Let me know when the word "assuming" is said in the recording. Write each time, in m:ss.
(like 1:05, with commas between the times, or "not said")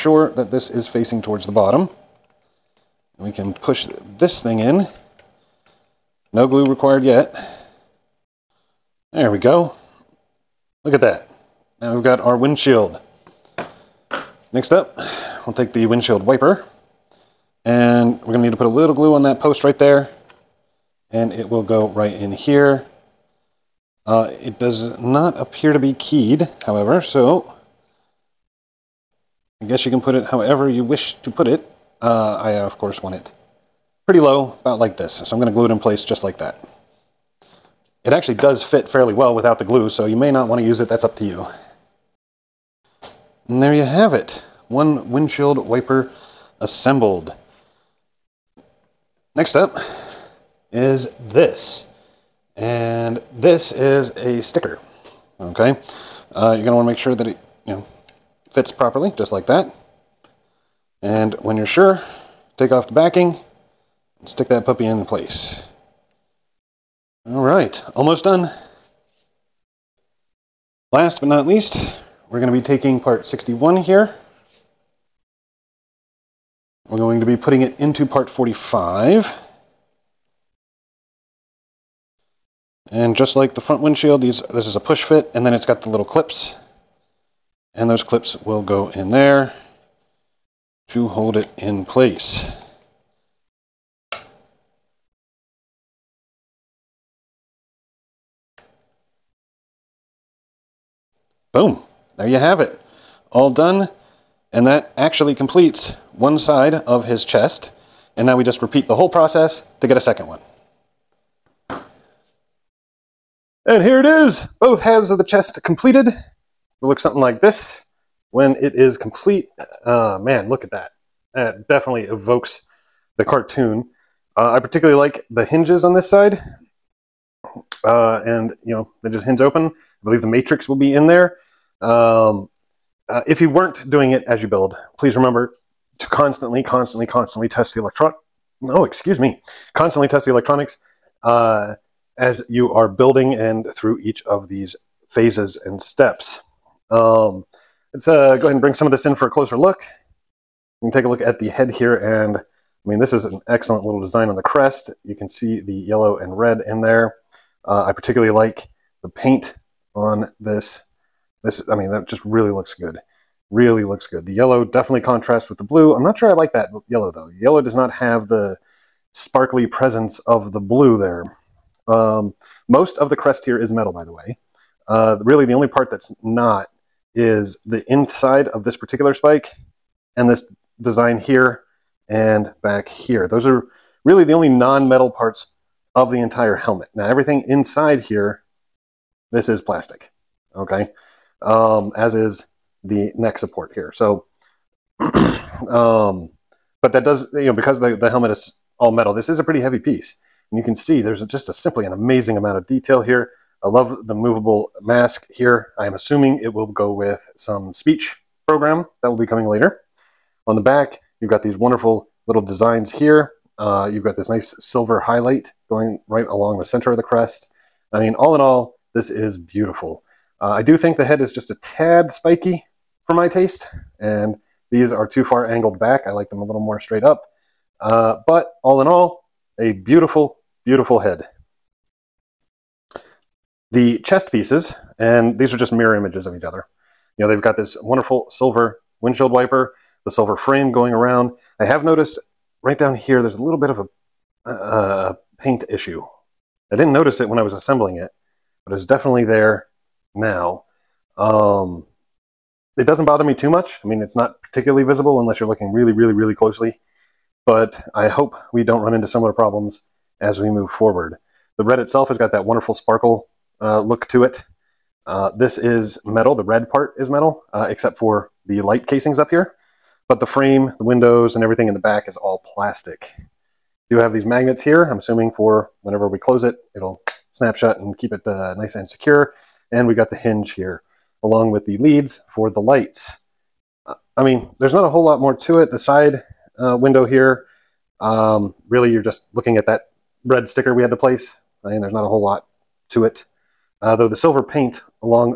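3:25, 4:34.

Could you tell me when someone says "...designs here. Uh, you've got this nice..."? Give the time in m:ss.
3:32.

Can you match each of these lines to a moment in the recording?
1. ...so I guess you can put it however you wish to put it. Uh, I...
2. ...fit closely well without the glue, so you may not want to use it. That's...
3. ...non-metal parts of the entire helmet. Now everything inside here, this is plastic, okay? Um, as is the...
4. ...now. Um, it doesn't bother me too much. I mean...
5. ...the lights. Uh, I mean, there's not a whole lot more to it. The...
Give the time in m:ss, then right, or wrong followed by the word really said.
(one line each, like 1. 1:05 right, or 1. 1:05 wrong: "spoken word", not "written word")
1. 0:27 right
2. 0:38 wrong: "fairly", not "closely"
3. 3:04 right
4. 4:10 right
5. 4:42 right.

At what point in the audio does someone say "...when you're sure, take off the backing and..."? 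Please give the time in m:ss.
1:01.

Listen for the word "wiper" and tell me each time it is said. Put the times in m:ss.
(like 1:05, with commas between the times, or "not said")
0:16, 0:45, 3:59.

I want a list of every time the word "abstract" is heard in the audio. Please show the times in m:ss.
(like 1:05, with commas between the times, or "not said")
not said.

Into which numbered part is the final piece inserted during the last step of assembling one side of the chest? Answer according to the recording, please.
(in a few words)
45.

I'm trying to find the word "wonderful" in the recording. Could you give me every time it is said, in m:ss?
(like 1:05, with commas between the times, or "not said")
3:31, 3:57, 4:22.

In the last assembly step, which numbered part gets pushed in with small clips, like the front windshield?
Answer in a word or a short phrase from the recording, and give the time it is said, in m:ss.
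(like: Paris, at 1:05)
61, at 1:12.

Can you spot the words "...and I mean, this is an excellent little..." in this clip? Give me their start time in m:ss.
2:31.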